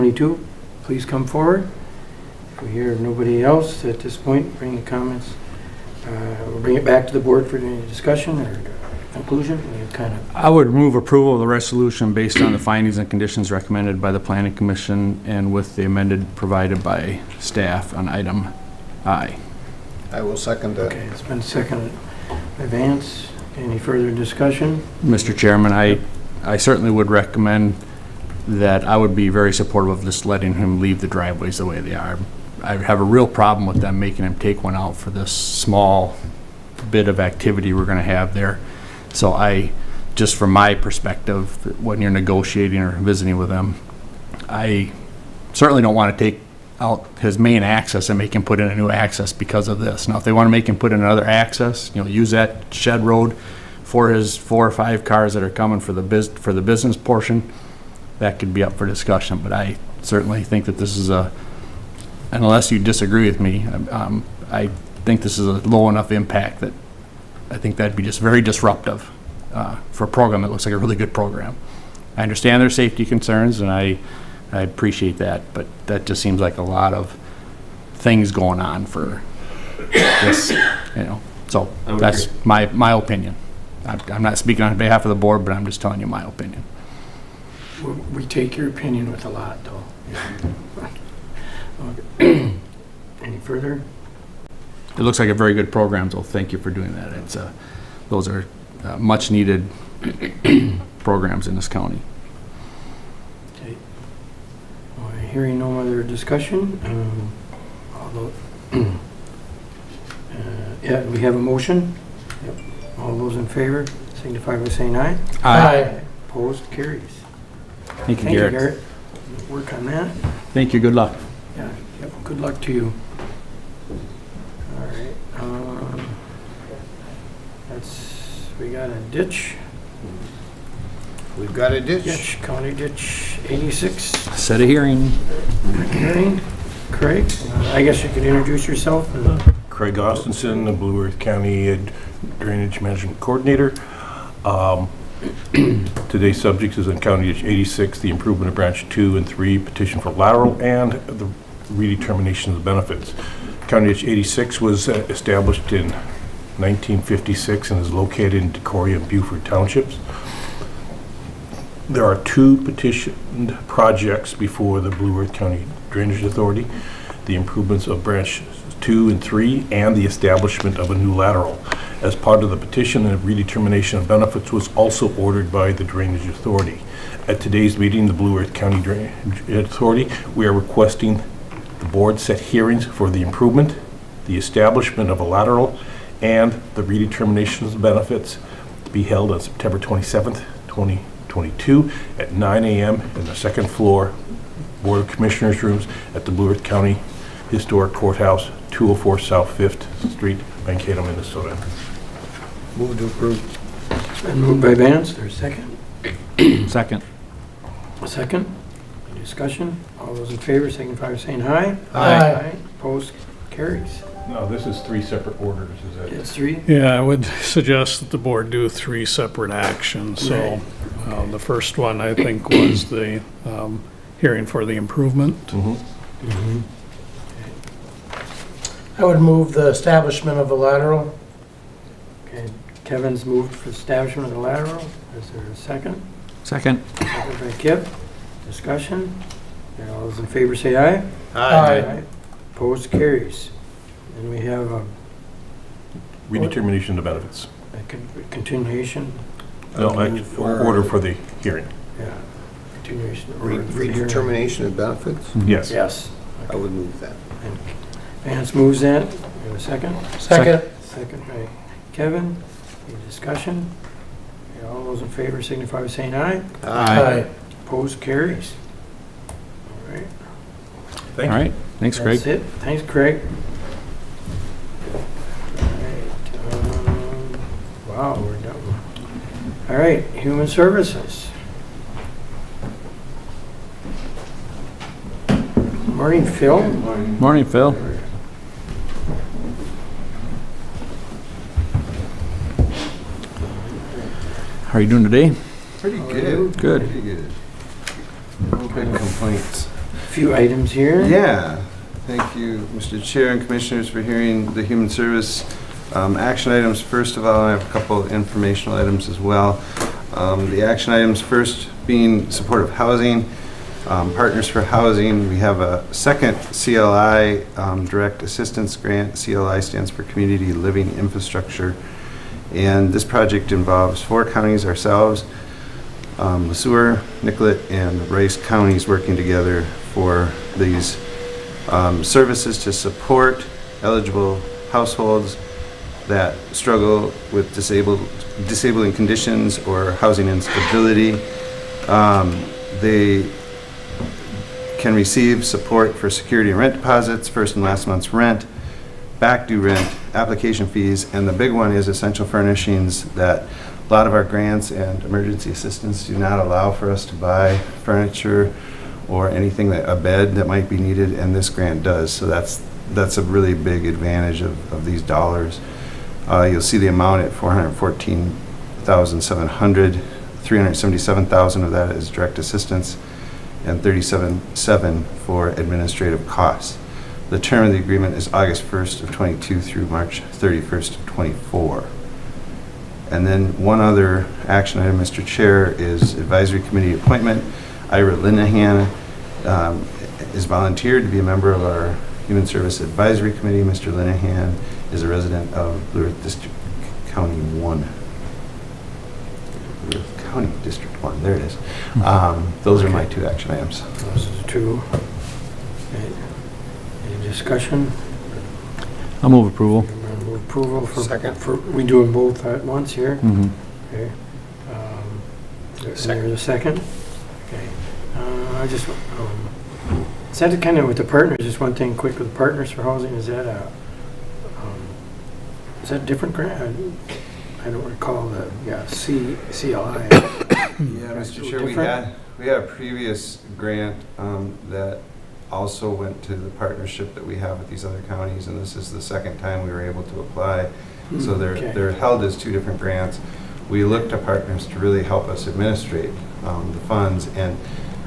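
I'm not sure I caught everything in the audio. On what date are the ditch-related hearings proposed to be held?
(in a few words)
September 27th, 2022.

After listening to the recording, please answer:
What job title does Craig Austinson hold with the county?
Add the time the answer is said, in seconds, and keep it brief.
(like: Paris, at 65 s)
Drainage Management Coordinator, at 142 s.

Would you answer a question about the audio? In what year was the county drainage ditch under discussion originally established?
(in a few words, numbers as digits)
1956.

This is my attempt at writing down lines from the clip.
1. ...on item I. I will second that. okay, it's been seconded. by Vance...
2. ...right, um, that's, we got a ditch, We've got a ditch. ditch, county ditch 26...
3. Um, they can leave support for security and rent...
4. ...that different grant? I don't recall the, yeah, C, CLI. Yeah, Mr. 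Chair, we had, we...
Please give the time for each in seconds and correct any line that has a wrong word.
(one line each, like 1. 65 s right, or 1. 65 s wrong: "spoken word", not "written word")
1. 17 s right
2. 124 s wrong: "86", not "26"
3. 341 s wrong: "receive", not "leave"
4. 425 s right.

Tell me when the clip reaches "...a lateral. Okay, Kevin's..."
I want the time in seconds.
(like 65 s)
230 s.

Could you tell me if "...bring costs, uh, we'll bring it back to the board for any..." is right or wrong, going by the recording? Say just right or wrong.
wrong.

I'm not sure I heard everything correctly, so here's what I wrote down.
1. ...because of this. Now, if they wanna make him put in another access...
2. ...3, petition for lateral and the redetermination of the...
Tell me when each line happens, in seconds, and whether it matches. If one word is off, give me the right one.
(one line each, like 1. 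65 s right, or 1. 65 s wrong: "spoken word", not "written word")
1. 49 s right
2. 149 s right.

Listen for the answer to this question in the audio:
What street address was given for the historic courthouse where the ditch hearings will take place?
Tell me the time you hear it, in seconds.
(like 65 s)
198 s.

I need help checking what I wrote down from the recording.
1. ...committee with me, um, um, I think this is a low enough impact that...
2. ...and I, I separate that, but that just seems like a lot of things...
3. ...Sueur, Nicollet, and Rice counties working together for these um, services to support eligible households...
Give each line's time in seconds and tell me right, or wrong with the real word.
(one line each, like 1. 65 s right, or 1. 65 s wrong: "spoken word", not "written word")
1. 62 s wrong: "disagree", not "committee"
2. 73 s wrong: "appreciate", not "separate"
3. 326 s right.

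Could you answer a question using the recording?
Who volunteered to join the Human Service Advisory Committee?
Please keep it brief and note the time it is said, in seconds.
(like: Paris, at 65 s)
Ira Linehan, at 387 s.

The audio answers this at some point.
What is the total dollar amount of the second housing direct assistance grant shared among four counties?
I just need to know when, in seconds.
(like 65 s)
367 s.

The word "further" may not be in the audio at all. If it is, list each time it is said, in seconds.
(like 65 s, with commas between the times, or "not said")
23 s, 93 s.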